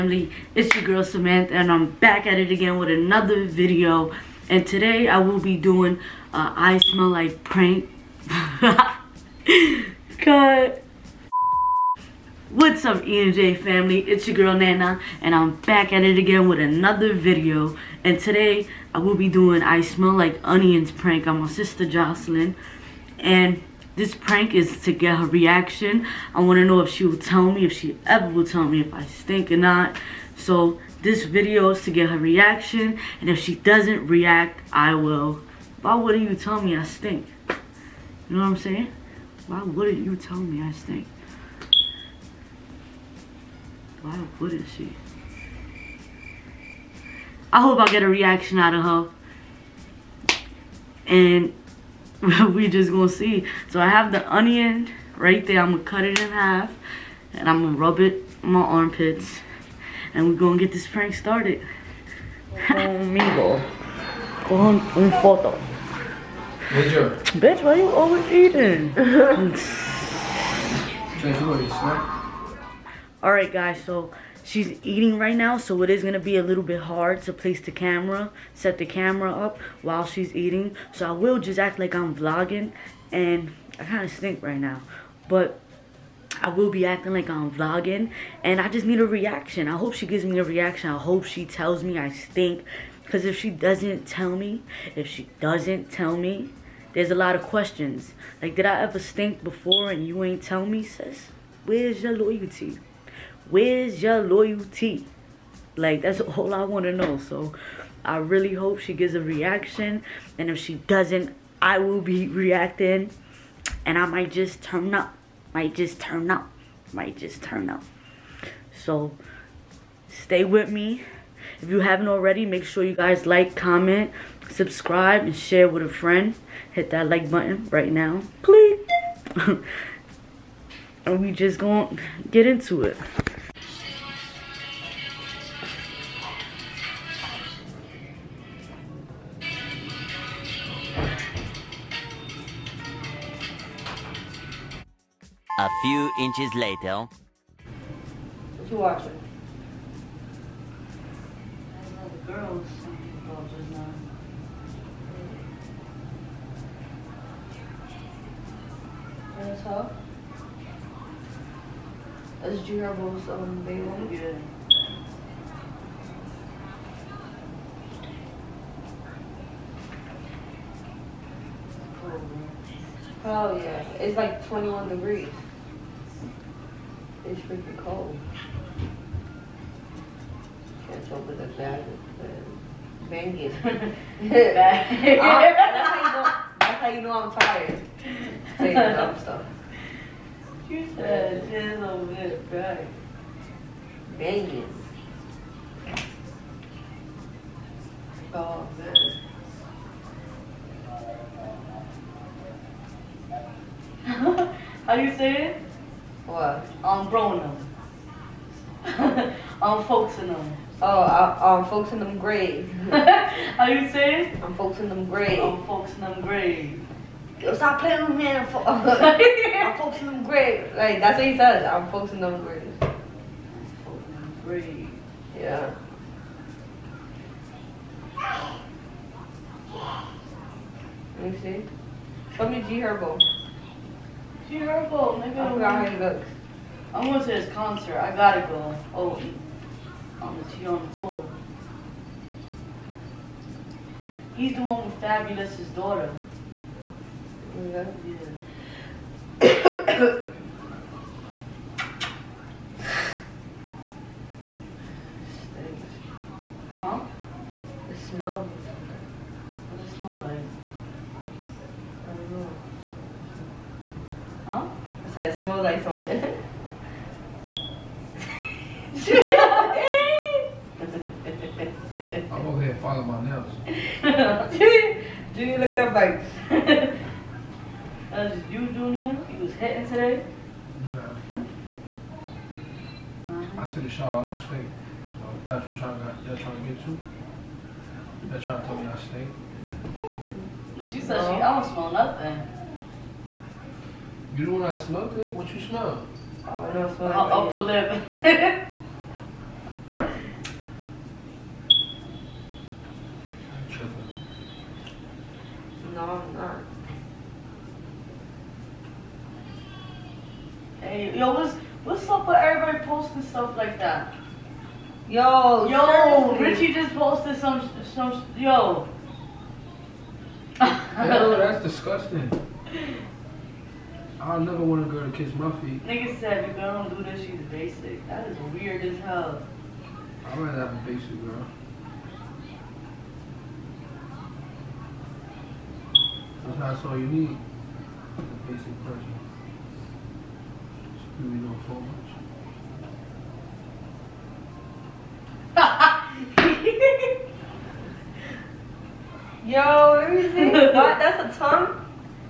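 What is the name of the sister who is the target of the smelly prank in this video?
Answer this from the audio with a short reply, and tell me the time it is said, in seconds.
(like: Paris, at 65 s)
Jocelyn, at 21 s.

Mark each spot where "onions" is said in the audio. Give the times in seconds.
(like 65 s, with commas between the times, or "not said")
20 s, 54 s.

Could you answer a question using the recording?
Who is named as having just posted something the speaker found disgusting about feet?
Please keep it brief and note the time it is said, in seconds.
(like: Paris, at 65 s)
Richie, at 316 s.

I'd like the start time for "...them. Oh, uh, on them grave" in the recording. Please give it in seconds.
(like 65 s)
210 s.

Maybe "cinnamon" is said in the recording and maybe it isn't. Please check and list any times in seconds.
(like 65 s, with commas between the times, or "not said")
not said.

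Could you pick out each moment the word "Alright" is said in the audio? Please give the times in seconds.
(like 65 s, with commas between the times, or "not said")
73 s.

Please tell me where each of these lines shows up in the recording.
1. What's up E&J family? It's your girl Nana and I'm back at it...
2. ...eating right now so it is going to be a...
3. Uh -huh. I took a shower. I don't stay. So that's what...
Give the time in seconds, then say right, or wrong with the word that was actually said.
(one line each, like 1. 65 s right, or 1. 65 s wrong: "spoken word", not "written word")
1. 12 s right
2. 74 s right
3. 283 s right.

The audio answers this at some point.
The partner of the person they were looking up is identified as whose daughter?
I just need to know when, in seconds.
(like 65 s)
245 s.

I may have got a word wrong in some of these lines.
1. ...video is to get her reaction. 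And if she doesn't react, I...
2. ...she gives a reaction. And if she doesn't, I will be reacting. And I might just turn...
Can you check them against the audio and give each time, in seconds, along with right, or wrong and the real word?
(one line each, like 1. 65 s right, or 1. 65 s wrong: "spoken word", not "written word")
1. 31 s right
2. 108 s right.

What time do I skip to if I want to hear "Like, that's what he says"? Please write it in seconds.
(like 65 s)
220 s.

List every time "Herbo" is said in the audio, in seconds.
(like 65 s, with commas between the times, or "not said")
162 s, 232 s.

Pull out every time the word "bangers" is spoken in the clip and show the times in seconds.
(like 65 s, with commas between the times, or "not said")
183 s, 194 s.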